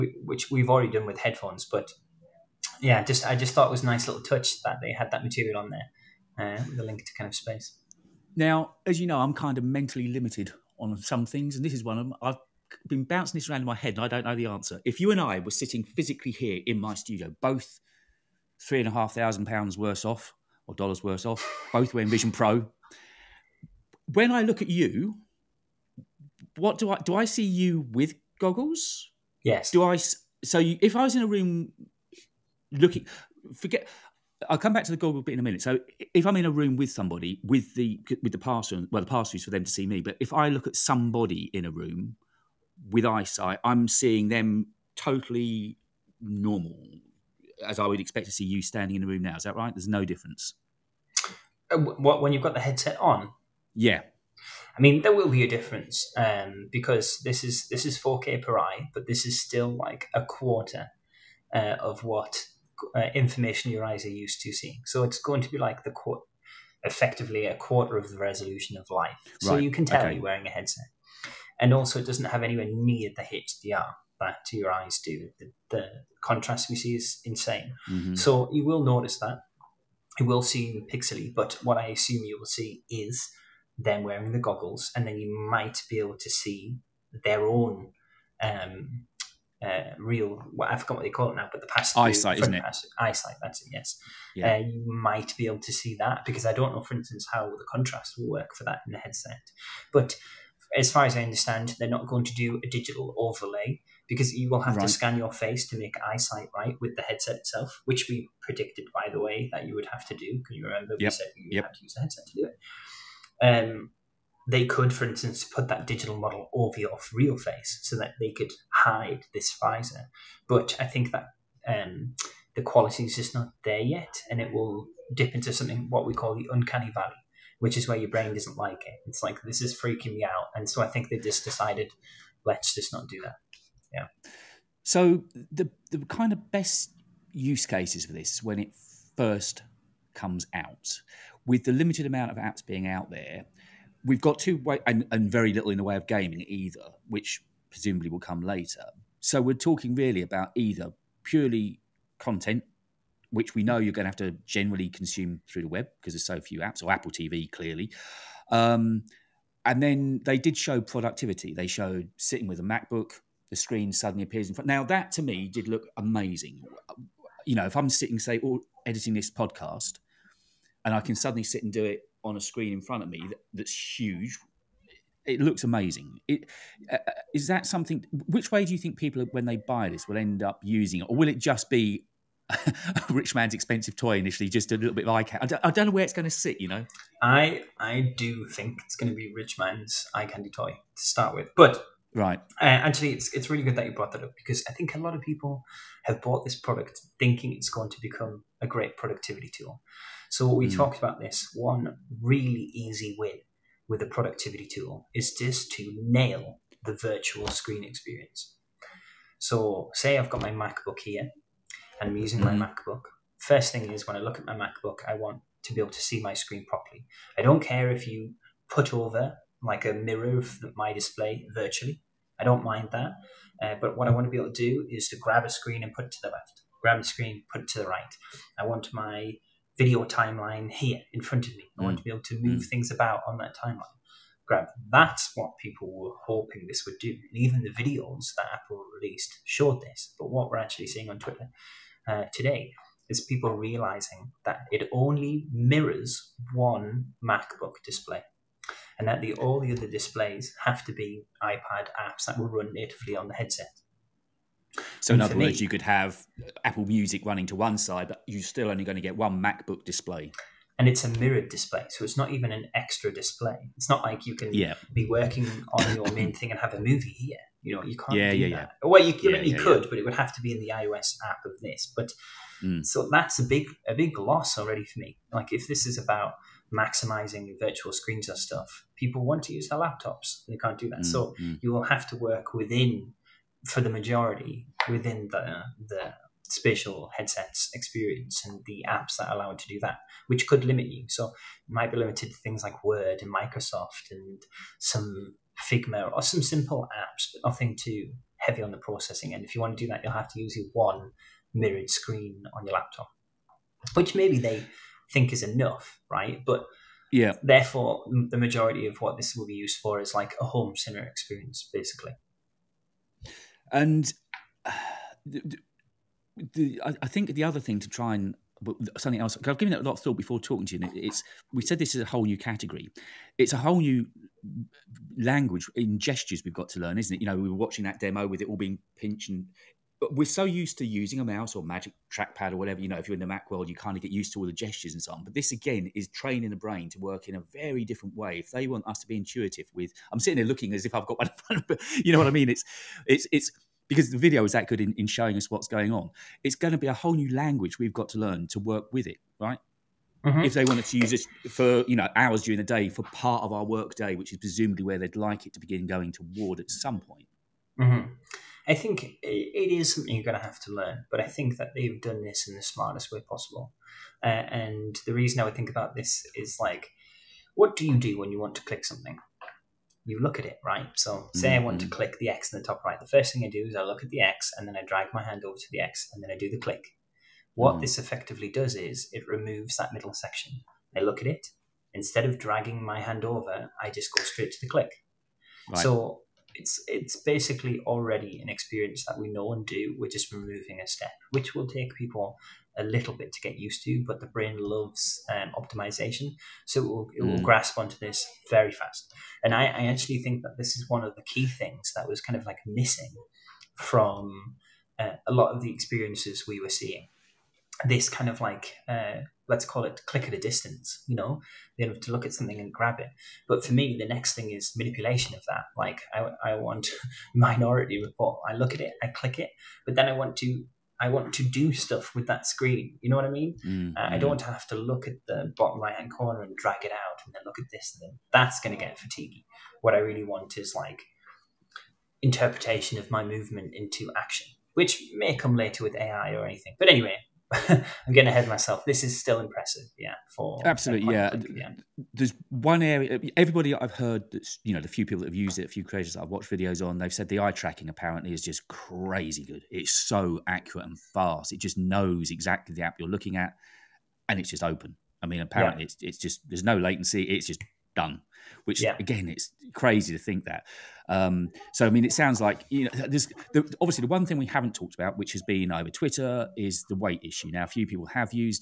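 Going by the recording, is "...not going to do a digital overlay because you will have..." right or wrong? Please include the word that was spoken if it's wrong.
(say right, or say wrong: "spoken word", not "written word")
right.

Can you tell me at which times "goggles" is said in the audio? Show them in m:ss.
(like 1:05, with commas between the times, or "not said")
0:28, 0:34, 1:24.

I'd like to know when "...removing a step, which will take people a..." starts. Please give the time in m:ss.
6:30.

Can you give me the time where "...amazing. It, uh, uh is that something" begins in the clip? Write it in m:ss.
2:55.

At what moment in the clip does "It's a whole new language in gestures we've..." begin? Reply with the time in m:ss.
5:23.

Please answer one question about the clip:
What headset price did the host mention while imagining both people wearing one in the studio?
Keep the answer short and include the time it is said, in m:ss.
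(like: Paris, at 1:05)
3,500 pounds, at 0:18.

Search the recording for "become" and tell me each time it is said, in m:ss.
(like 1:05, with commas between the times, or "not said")
3:18.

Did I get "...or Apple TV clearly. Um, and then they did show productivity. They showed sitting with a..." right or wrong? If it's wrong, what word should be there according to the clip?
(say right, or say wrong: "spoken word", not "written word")
right.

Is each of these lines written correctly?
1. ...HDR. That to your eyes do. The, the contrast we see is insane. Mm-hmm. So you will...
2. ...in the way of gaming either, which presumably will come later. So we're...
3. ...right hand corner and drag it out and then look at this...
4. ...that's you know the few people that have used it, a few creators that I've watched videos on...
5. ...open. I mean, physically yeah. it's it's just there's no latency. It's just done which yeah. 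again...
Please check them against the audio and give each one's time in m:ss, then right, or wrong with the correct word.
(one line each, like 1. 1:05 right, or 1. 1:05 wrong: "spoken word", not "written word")
1. 1:13 right
2. 2:25 right
3. 7:05 right
4. 7:24 right
5. 7:34 wrong: "apparently", not "physically".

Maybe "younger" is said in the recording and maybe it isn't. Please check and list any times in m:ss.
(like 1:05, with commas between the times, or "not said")
not said.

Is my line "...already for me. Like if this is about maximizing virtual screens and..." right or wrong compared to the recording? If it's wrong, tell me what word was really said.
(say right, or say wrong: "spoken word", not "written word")
right.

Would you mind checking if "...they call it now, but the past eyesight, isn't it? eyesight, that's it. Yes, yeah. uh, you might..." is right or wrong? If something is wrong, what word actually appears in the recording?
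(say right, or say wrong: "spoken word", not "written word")
right.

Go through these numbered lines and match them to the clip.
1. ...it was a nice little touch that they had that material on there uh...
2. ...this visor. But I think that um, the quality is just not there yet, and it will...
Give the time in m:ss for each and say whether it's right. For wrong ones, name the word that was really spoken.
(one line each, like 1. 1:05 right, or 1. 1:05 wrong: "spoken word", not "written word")
1. 0:03 right
2. 1:59 right.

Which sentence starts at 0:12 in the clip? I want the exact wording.
I've been bouncing this around in my head, and I don't know the answer.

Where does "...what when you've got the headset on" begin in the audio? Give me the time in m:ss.
0:51.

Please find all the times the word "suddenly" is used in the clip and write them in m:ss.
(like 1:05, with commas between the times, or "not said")
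2:43, 2:51.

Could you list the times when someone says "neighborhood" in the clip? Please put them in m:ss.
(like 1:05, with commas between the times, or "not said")
not said.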